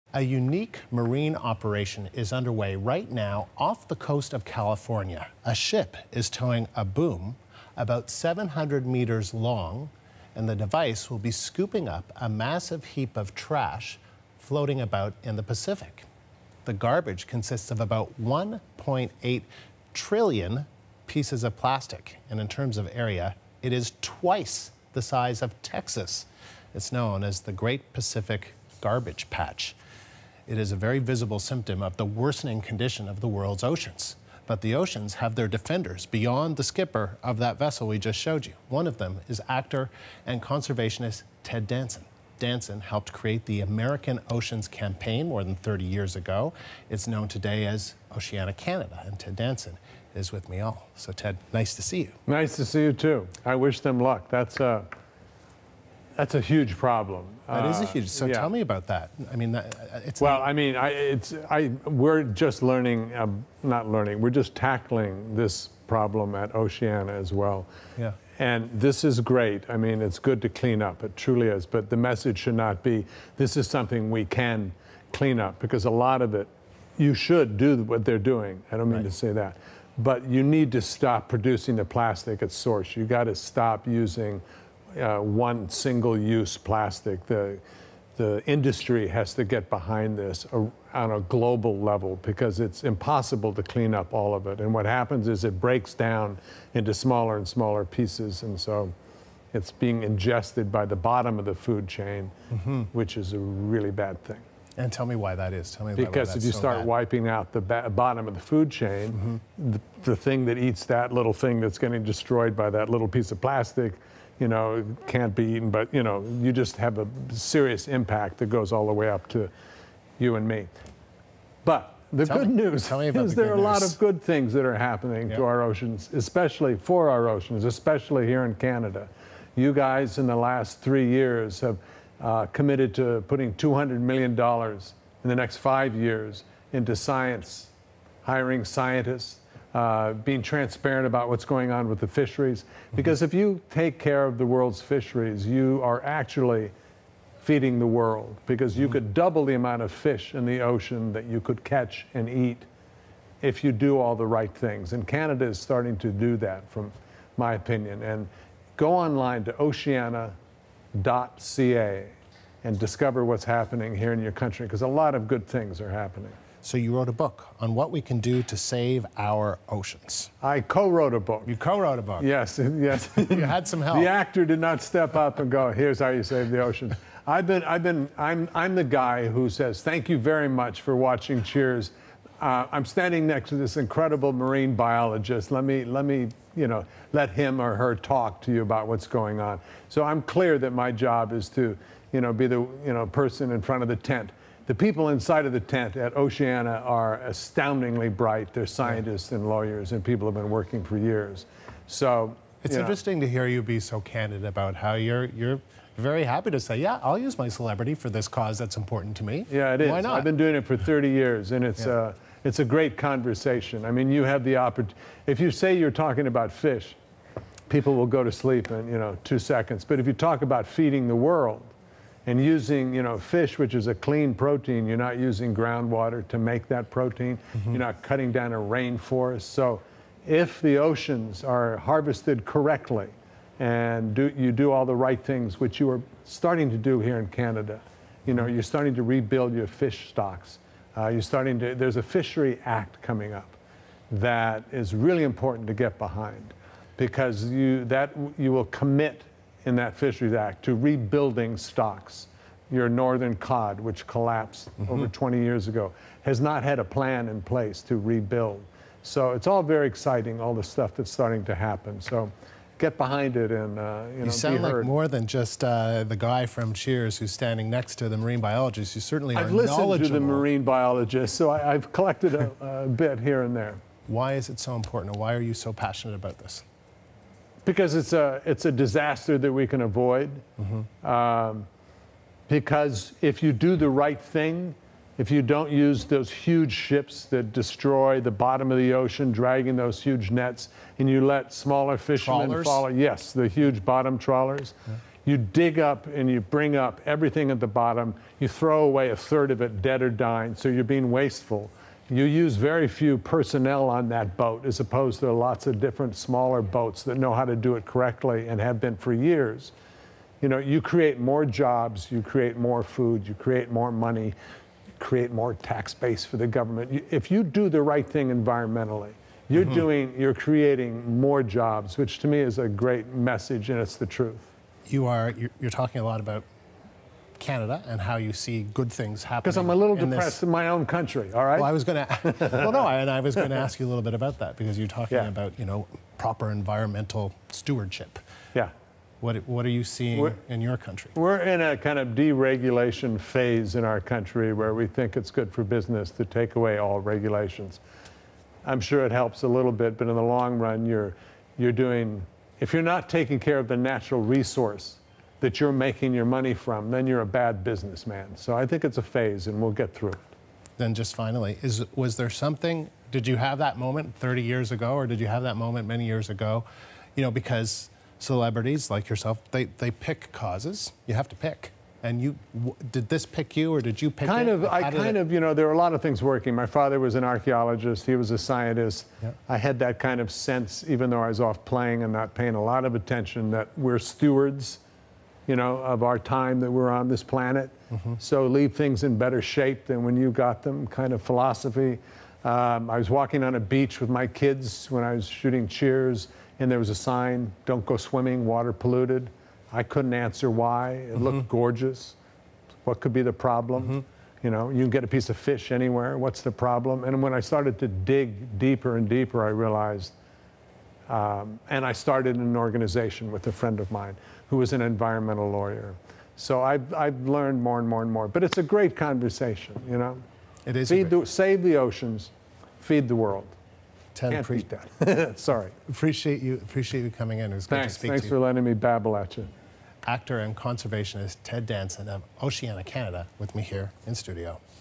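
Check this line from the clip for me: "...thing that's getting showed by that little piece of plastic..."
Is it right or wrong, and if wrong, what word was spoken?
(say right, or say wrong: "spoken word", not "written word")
wrong: "destroyed", not "showed".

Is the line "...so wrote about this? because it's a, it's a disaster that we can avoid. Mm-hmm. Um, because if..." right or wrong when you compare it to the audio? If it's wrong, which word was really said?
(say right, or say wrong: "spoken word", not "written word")
wrong: "passionate", not "wrote".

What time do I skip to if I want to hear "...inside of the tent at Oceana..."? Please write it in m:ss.
3:15.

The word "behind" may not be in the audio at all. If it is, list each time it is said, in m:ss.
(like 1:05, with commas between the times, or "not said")
1:29, 4:05, 4:22.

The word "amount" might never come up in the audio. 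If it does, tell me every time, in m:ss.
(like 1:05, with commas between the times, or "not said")
2:29.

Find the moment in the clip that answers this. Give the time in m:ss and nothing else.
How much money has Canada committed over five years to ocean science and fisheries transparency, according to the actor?
2:13.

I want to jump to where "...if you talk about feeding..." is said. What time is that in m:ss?
3:39.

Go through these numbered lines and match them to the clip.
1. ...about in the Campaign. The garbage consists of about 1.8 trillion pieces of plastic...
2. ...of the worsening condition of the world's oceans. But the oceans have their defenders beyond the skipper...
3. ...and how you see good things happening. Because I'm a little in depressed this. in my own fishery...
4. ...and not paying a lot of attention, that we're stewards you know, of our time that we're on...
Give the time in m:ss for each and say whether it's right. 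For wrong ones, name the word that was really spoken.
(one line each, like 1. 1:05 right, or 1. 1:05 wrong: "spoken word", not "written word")
1. 0:14 wrong: "Pacific", not "Campaign"
2. 0:31 right
3. 5:27 wrong: "country", not "fishery"
4. 6:22 right.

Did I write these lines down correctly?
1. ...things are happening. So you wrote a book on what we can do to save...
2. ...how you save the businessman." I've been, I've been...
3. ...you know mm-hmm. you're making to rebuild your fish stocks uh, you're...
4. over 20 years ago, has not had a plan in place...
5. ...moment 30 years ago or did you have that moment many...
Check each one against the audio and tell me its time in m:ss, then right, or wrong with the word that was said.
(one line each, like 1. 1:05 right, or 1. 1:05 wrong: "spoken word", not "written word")
1. 2:45 right
2. 2:55 wrong: "ocean", not "businessman"
3. 3:58 wrong: "starting", not "making"
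4. 4:14 right
5. 6:03 right.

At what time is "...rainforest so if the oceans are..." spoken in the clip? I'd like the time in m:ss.
3:48.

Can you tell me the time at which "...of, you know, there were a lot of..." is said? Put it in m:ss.
6:15.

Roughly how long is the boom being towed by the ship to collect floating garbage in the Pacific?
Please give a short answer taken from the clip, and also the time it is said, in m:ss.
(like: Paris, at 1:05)
700 meters, at 0:08.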